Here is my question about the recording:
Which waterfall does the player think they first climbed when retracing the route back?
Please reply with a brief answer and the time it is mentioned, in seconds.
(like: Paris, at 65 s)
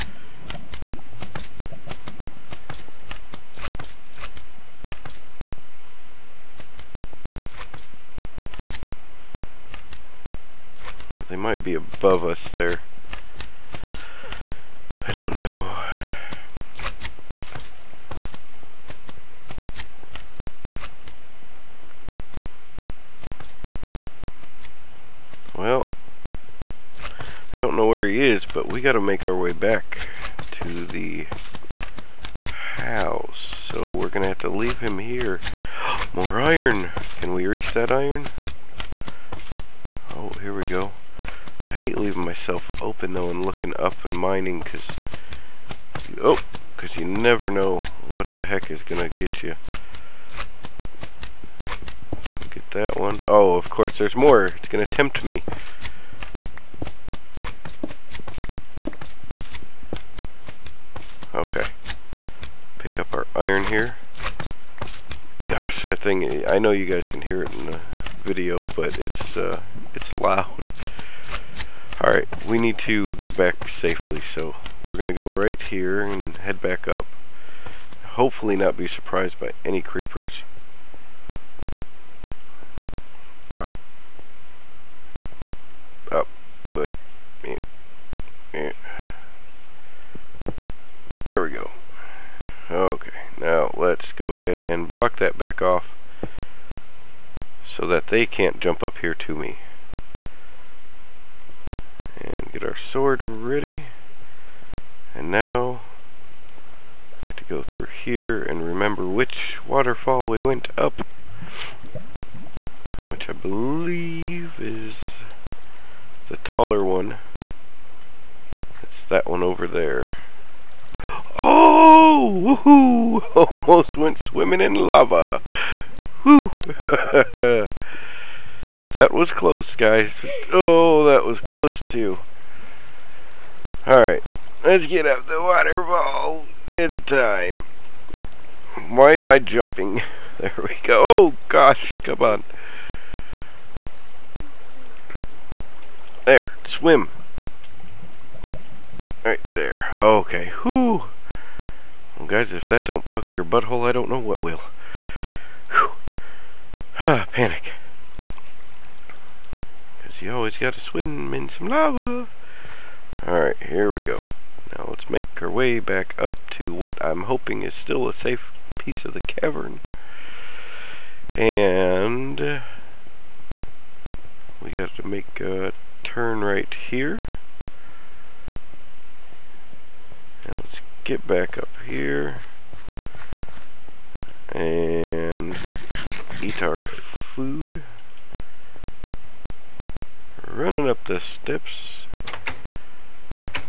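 The taller one, at 116 s.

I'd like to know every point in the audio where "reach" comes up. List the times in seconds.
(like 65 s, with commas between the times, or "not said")
37 s.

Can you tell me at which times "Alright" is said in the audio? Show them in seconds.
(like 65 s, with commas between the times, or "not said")
71 s, 133 s, 163 s.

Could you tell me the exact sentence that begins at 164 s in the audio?
Now let's make our way back up to what I'm hoping is still a safe piece of the cavern.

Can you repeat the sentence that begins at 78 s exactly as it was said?
Hopefully not be surprised by any creepers.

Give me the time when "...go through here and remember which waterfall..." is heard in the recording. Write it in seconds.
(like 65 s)
107 s.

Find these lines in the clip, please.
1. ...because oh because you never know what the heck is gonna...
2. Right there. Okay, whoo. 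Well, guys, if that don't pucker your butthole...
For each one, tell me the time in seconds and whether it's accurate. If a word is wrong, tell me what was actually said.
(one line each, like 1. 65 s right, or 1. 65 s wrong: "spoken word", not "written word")
1. 44 s right
2. 149 s right.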